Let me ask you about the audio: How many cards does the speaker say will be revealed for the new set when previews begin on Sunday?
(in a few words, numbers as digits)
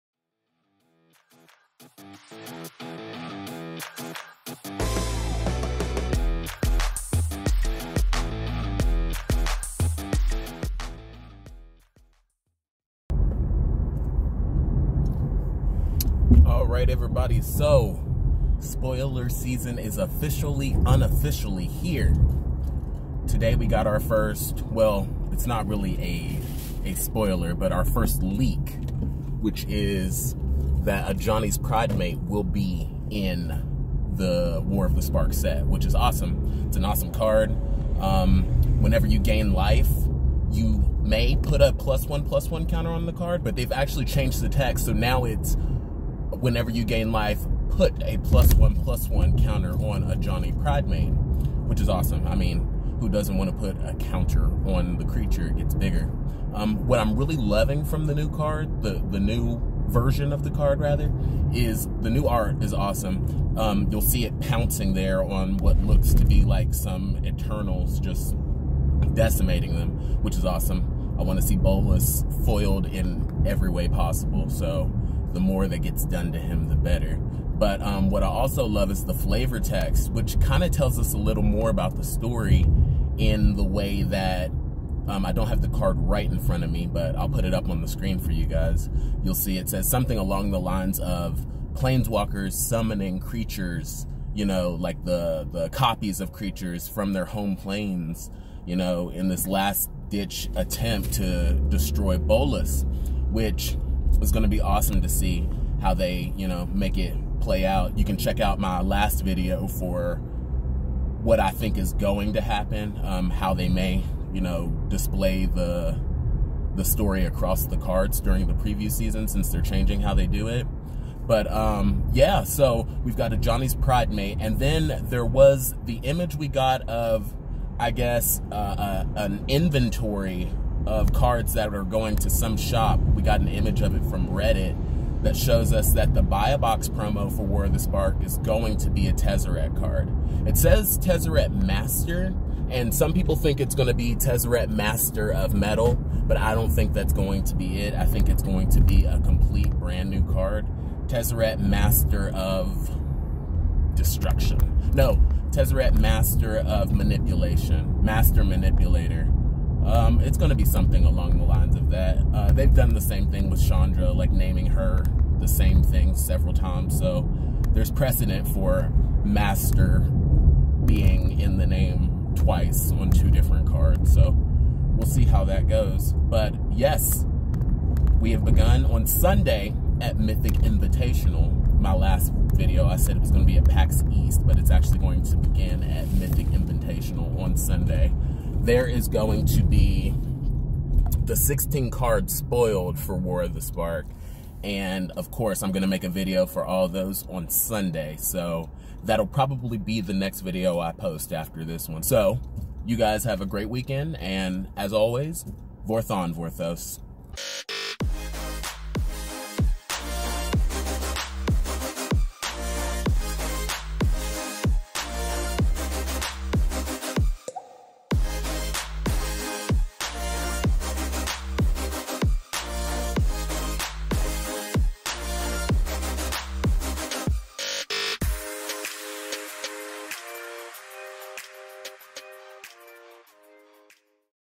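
16.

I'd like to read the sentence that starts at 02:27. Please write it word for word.
I think it's going to be a complete brand new card.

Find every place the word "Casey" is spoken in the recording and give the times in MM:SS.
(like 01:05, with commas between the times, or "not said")
not said.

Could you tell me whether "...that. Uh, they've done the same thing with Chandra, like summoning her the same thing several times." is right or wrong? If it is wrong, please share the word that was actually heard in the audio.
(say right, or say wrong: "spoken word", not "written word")
wrong: "naming", not "summoning".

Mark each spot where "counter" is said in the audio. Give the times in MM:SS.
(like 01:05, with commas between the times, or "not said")
00:42, 00:49, 00:53.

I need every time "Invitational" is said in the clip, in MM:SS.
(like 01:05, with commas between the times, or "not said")
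03:00, 03:06.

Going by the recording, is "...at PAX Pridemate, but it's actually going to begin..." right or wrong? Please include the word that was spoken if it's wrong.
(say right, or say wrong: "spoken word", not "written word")
wrong: "East", not "Pridemate".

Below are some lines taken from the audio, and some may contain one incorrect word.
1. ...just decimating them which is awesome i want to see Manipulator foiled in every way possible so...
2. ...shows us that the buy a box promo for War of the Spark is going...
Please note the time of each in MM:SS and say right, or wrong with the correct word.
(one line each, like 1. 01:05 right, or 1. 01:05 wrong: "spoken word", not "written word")
1. 01:07 wrong: "Bolas", not "Manipulator"
2. 02:15 right.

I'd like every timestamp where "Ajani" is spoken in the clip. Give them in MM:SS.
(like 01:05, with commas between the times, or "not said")
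00:31, 00:50, 02:03.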